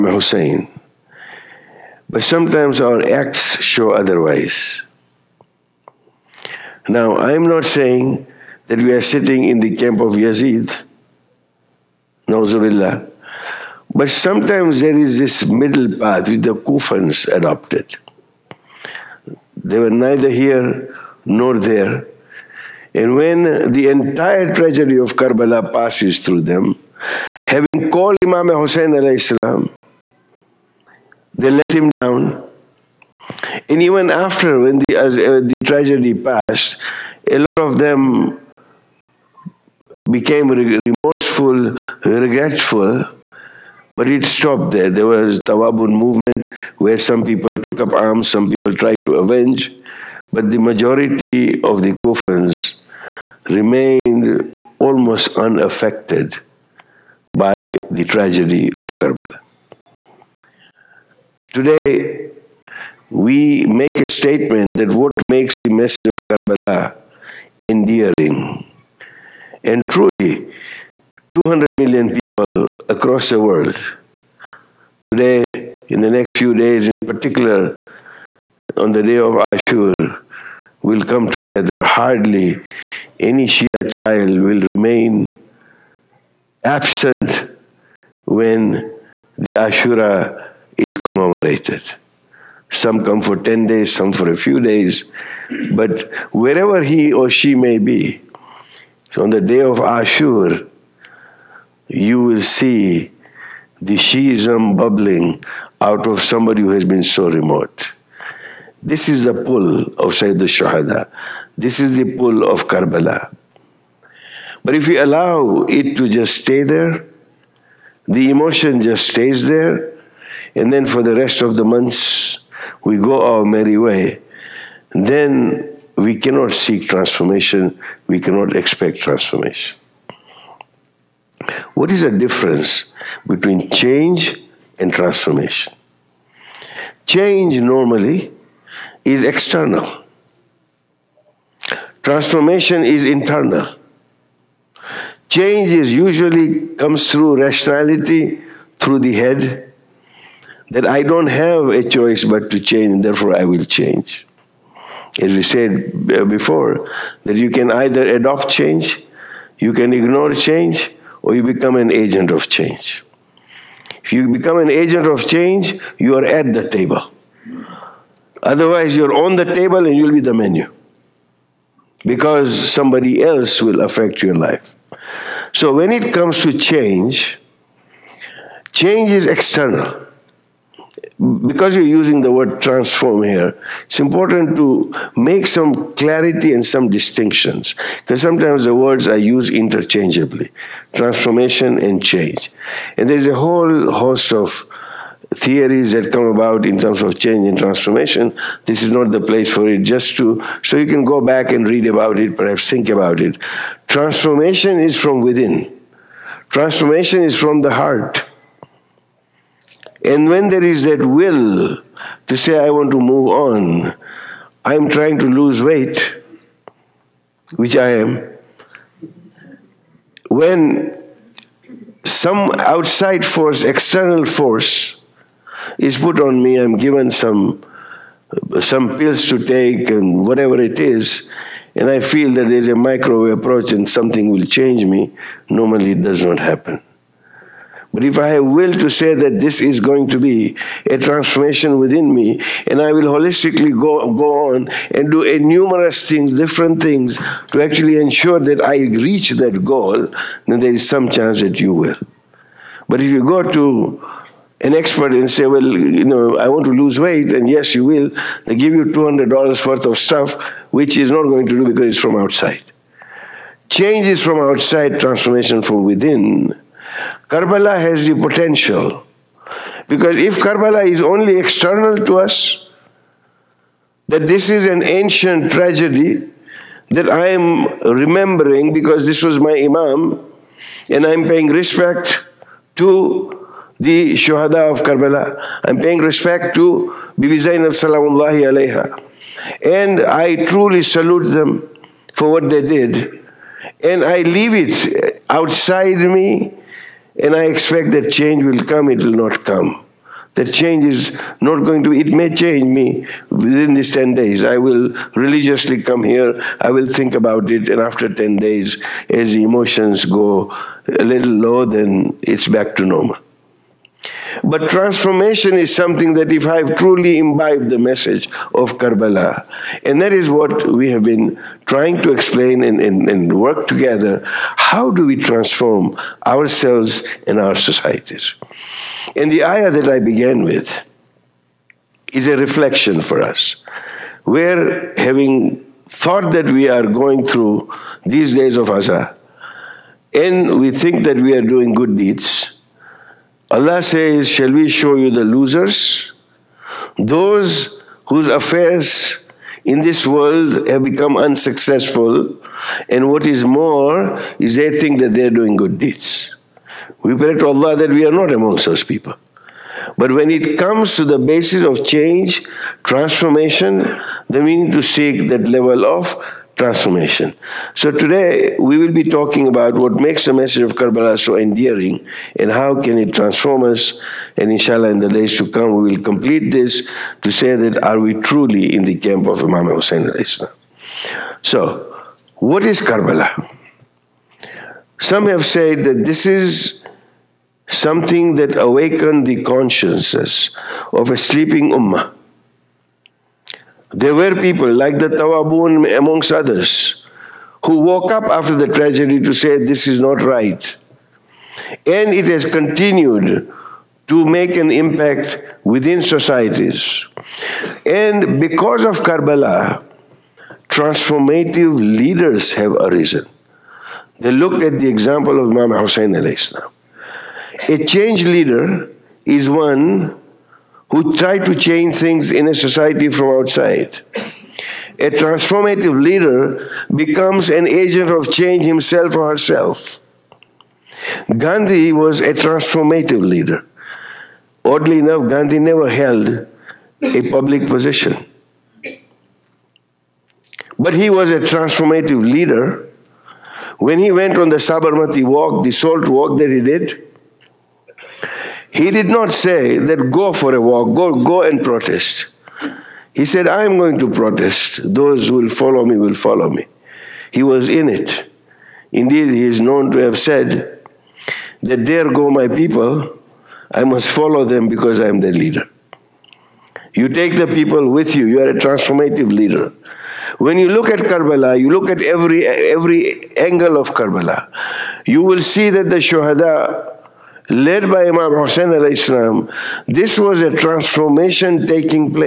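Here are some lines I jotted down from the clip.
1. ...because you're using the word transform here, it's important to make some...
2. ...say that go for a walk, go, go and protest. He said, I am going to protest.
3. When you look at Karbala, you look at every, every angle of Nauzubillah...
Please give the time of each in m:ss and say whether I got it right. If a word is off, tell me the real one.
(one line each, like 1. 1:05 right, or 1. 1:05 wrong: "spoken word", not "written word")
1. 3:01 right
2. 7:29 right
3. 7:50 wrong: "Karbala", not "Nauzubillah".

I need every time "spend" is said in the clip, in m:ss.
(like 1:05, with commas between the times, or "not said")
not said.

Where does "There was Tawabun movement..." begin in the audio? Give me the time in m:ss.
0:44.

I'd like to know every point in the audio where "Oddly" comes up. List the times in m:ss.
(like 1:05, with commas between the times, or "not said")
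7:14.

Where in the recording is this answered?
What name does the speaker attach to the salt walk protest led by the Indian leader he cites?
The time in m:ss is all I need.
7:24.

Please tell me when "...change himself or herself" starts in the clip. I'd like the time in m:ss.
7:08.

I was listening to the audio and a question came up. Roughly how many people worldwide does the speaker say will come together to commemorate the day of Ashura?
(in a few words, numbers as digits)
200 million.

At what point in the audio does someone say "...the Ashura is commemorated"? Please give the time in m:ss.
1:29.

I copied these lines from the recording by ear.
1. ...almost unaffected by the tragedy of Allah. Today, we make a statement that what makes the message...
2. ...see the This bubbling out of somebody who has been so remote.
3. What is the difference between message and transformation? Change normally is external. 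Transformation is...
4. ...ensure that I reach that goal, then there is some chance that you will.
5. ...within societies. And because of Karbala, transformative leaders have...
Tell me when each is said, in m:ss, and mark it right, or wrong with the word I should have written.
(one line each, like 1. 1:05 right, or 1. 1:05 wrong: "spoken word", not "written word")
1. 0:54 wrong: "Karbala", not "Allah"
2. 1:42 wrong: "Shiism", not "This"
3. 2:11 wrong: "change", not "message"
4. 4:07 right
5. 6:45 right.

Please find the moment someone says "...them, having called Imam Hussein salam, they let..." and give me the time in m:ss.
0:26.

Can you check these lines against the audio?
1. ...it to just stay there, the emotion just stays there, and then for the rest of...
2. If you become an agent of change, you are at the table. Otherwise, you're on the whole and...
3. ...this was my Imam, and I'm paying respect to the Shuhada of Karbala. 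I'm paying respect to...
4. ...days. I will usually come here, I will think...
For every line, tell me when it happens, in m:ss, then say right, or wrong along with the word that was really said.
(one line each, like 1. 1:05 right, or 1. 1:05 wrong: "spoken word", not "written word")
1. 1:55 right
2. 2:44 wrong: "table", not "whole"
3. 4:39 right
4. 5:04 wrong: "religiously", not "usually".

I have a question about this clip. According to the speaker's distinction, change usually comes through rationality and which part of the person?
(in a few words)
The head.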